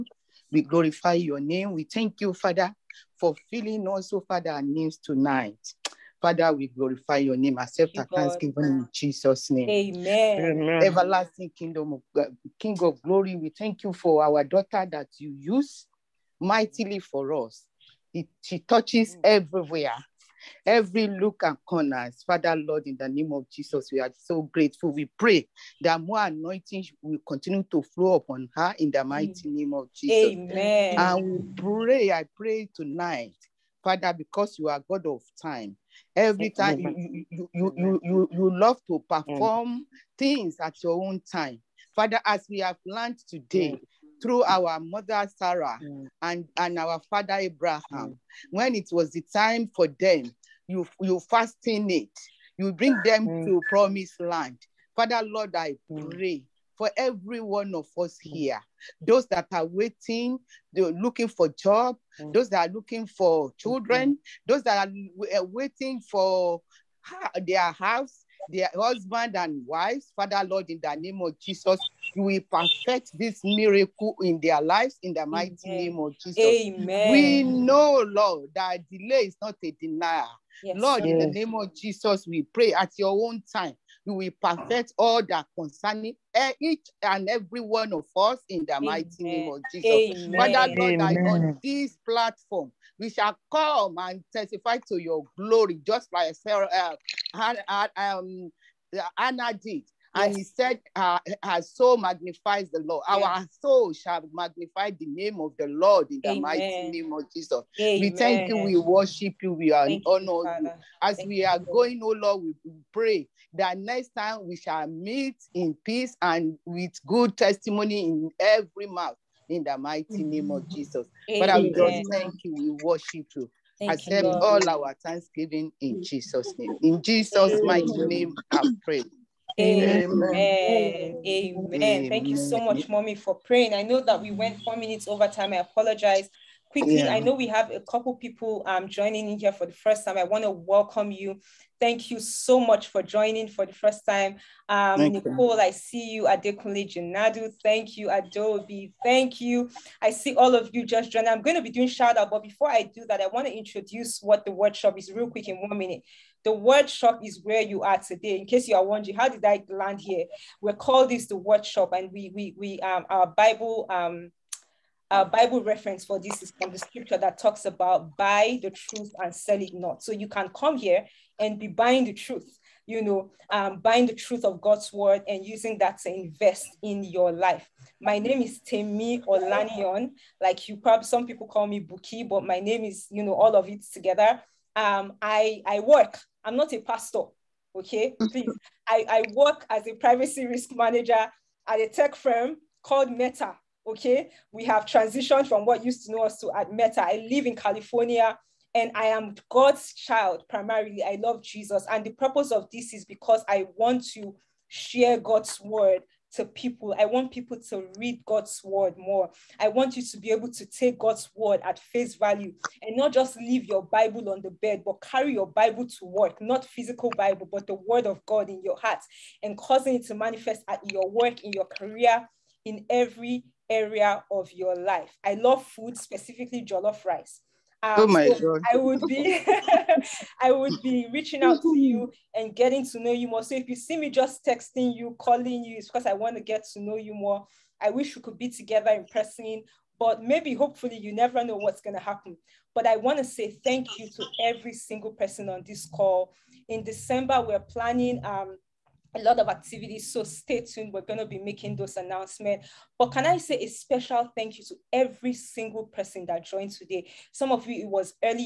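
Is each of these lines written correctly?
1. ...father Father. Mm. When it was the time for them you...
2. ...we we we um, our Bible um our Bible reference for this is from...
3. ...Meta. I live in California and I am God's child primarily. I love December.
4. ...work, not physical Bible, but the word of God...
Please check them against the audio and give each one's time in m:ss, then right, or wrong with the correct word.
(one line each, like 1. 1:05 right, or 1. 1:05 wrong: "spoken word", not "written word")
1. 0:47 wrong: "Abraham", not "Father"
2. 2:42 right
3. 3:16 wrong: "Jesus", not "December"
4. 3:36 right.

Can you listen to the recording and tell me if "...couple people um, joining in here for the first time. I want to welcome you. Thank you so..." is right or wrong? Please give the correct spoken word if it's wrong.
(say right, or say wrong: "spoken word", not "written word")
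right.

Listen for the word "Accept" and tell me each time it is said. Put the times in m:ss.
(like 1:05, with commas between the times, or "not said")
0:07, 2:03.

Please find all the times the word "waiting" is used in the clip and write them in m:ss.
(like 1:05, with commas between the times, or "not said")
0:59, 1:05.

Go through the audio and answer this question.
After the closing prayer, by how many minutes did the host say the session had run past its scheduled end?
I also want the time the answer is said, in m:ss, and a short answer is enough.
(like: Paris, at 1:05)
4, at 2:14.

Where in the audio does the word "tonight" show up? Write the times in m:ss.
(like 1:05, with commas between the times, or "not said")
0:04, 0:32.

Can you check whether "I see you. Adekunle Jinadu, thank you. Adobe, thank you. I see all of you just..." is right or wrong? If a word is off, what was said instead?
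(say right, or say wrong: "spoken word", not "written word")
right.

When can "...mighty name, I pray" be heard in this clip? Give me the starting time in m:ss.
2:07.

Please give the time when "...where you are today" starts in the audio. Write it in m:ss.
2:37.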